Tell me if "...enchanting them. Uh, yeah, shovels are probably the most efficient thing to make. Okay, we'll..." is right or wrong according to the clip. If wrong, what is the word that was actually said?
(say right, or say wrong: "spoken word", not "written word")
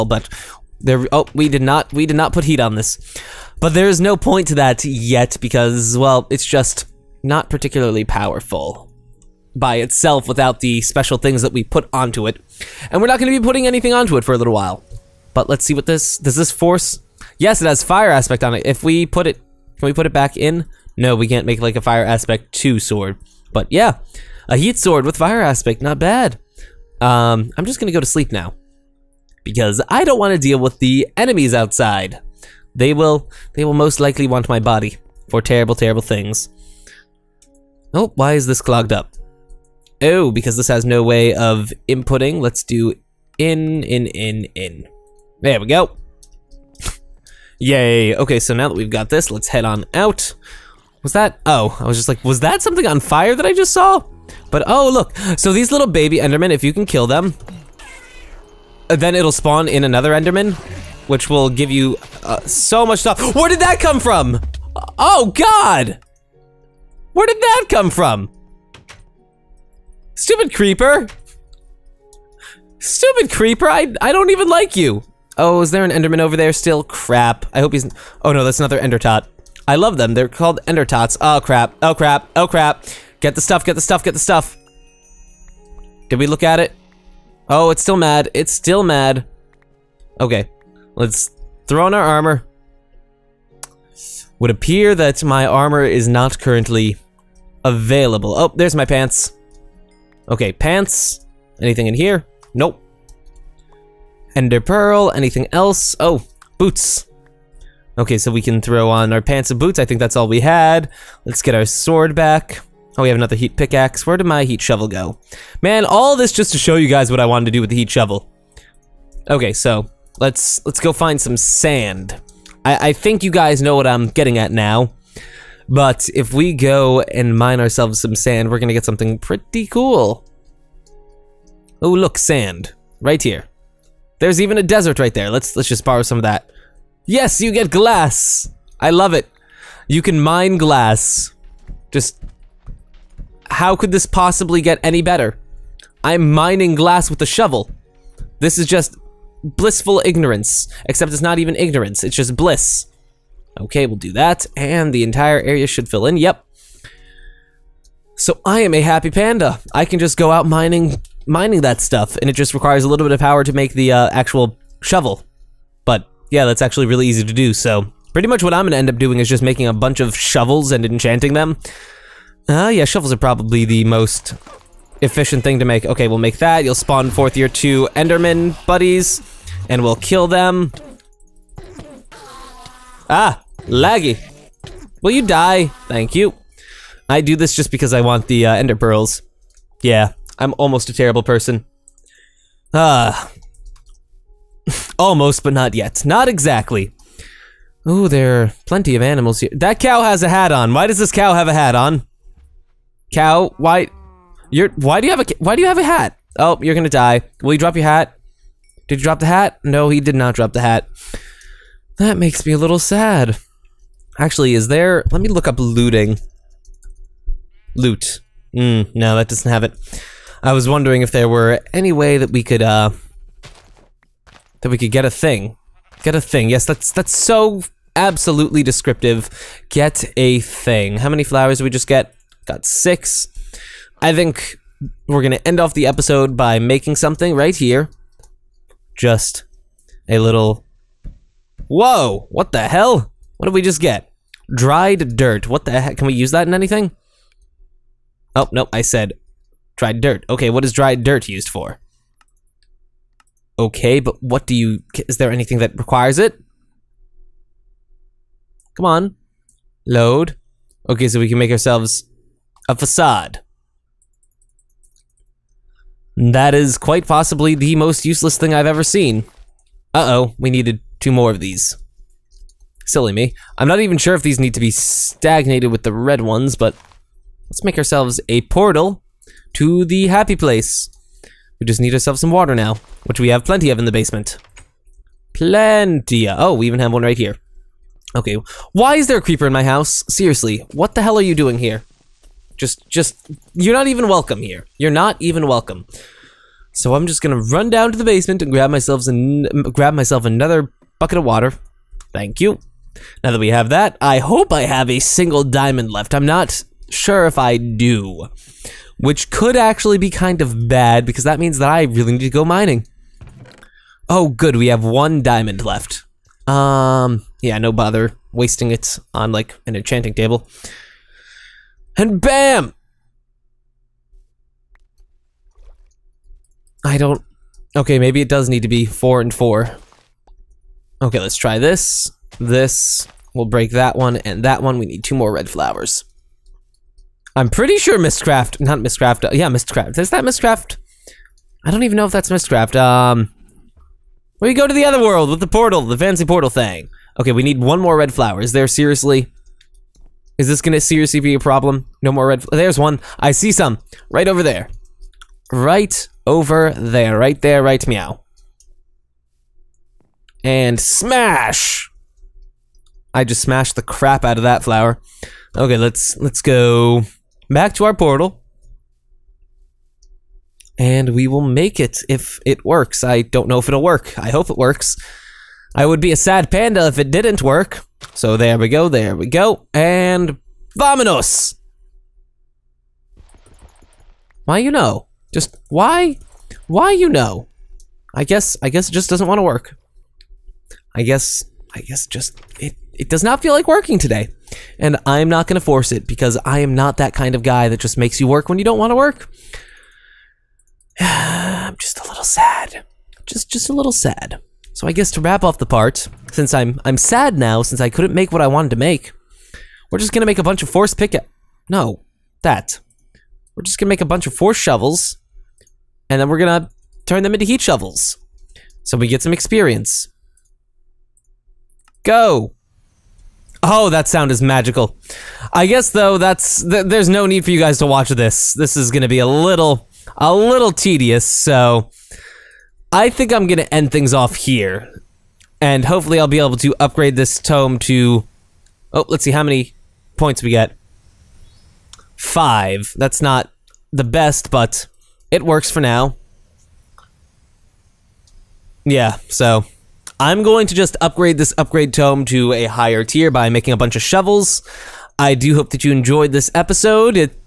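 right.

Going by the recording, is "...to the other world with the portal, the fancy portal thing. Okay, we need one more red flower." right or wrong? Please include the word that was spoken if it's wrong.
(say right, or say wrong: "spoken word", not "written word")
right.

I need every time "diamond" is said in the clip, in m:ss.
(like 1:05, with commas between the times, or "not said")
5:05, 5:15.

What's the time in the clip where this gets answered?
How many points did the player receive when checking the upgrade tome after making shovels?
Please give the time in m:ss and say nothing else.
7:22.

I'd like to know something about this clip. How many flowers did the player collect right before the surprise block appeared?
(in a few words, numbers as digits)
6.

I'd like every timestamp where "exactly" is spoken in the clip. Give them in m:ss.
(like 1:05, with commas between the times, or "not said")
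3:16.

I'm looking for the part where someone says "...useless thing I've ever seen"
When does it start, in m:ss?
4:28.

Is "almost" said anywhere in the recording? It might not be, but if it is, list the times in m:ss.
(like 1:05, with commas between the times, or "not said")
3:10, 3:14.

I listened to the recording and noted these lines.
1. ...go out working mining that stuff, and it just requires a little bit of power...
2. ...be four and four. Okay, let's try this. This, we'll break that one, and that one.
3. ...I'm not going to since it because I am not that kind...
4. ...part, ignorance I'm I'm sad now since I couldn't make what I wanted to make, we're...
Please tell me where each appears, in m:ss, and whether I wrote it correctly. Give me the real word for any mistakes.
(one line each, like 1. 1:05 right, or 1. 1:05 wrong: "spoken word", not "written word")
1. 2:40 wrong: "mining", not "working"
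2. 5:28 right
3. 6:35 wrong: "force", not "since"
4. 6:45 wrong: "since", not "ignorance".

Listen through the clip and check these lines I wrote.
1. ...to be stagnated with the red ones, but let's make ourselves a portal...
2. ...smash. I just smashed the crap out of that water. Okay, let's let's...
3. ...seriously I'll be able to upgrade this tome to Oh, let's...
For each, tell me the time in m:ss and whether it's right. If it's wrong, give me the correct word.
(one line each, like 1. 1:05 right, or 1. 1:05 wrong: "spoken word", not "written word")
1. 4:34 right
2. 6:00 wrong: "flower", not "water"
3. 7:15 wrong: "hopefully", not "seriously".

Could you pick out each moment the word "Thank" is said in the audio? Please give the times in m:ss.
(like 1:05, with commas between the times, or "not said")
3:05, 5:02.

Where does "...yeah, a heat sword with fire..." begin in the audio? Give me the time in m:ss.
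0:23.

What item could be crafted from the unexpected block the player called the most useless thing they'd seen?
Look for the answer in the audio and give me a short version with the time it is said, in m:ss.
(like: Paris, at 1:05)
A facade, at 4:22.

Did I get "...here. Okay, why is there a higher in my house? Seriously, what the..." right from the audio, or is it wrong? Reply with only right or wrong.
wrong.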